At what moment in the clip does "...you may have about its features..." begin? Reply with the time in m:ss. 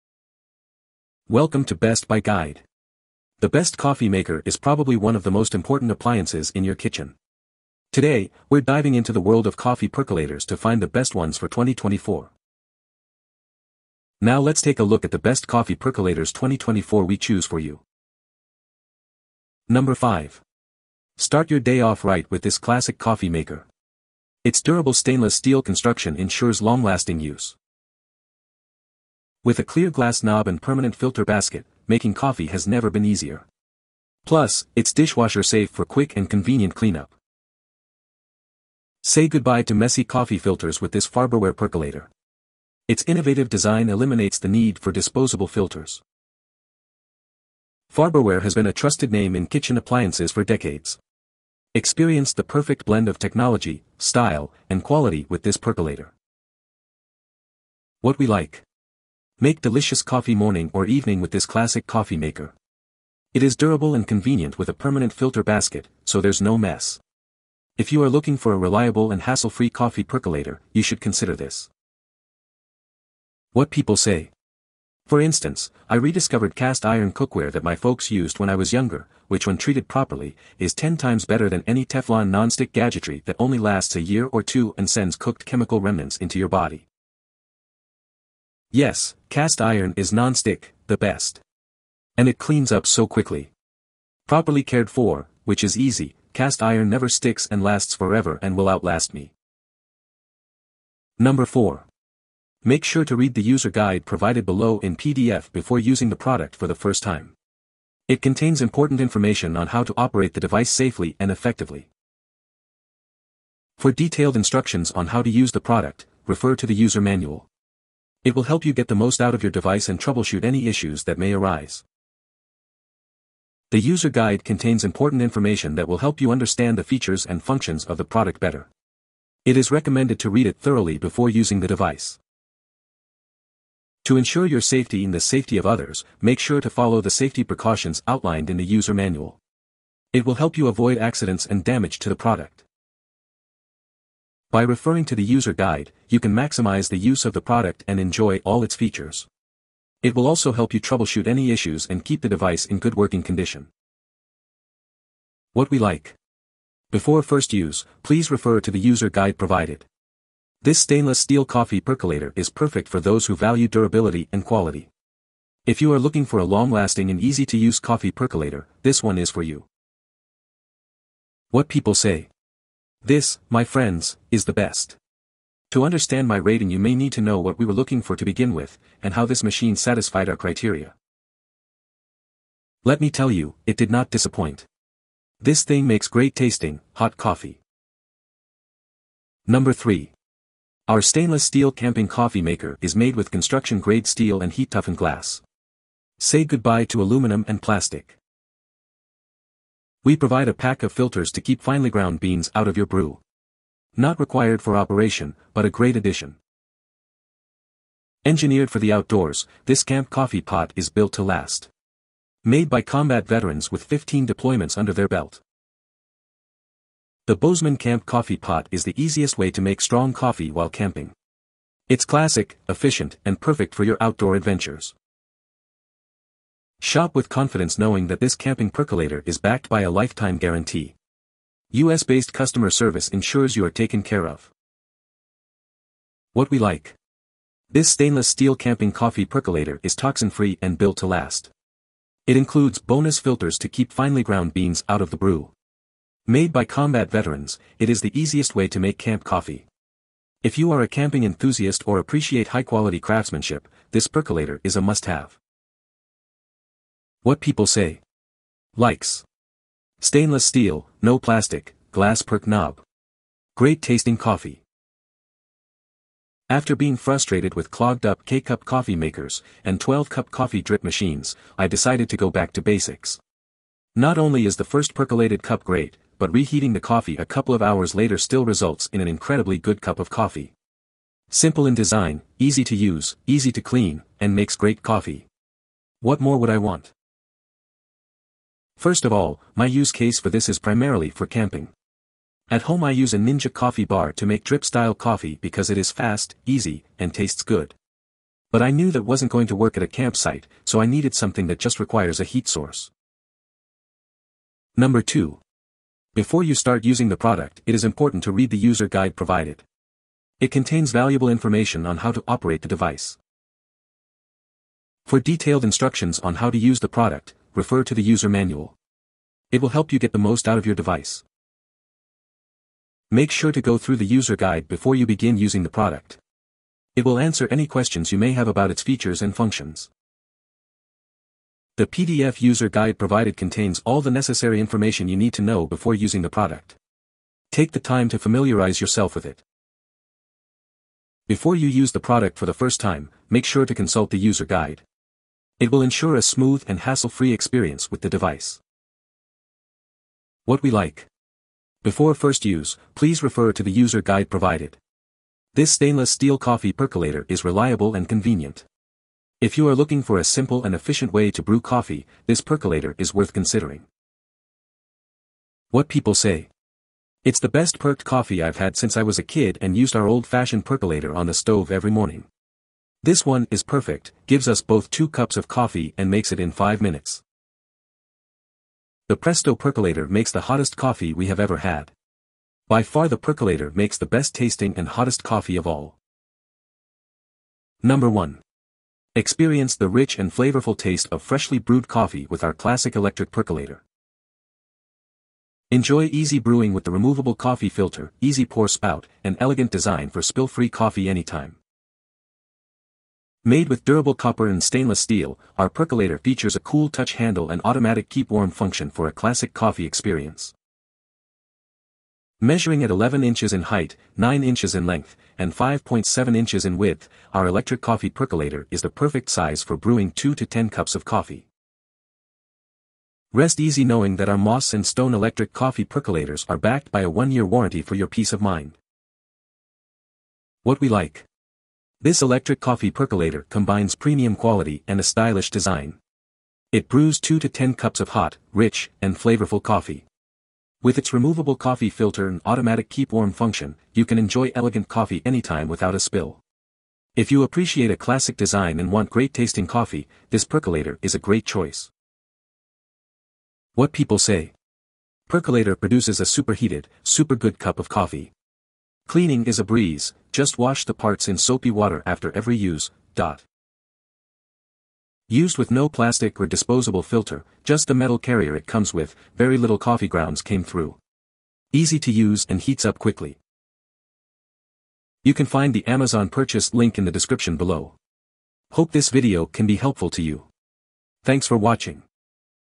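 5:28.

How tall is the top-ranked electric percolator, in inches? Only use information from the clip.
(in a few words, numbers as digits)
11 inches.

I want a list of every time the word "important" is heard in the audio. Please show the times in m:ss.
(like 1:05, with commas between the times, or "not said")
0:05, 1:48, 2:04, 5:07.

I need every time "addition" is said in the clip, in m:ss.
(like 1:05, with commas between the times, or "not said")
3:25.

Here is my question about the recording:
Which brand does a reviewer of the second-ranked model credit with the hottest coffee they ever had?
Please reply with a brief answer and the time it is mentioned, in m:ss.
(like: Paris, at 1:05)
Presto, at 6:19.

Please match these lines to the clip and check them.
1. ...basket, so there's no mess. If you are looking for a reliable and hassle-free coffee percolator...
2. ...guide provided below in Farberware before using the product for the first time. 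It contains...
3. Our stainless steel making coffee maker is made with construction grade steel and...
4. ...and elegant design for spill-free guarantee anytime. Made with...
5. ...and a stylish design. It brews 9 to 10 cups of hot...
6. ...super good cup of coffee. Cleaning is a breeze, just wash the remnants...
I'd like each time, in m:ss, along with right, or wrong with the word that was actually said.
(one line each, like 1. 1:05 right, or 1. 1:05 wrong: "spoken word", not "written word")
1. 1:05 right
2. 1:43 wrong: "PDF", not "Farberware"
3. 3:10 wrong: "camping", not "making"
4. 6:39 wrong: "coffee", not "guarantee"
5. 7:14 wrong: "2", not "9"
6. 7:37 wrong: "parts", not "remnants".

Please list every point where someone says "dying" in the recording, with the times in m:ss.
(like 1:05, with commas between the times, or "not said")
not said.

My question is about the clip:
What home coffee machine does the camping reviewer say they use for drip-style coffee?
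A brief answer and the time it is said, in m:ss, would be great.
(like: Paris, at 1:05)
Ninja coffee bar, at 4:53.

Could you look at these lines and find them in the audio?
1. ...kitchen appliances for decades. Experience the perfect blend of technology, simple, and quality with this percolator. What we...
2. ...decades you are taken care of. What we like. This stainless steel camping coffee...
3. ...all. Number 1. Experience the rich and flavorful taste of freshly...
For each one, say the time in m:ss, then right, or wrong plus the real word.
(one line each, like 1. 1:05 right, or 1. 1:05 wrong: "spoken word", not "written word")
1. 0:49 wrong: "style", not "simple"
2. 3:53 wrong: "ensures", not "decades"
3. 6:25 right.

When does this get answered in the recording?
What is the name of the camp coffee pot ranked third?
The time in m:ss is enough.
3:37.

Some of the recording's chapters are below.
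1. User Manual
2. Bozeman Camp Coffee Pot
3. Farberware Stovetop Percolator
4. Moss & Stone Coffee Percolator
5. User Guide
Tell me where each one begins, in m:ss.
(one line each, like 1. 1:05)
1. 1:39
2. 3:08
3. 0:18
4. 6:26
5. 5:03.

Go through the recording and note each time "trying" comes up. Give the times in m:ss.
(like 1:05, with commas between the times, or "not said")
not said.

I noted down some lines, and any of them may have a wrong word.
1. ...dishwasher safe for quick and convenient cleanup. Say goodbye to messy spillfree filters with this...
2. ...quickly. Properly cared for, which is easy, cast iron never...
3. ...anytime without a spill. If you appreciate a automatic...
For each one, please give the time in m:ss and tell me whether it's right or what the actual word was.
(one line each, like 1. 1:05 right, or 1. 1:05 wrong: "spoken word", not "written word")
1. 0:34 wrong: "coffee", not "spillfree"
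2. 1:33 right
3. 7:25 wrong: "classic", not "automatic".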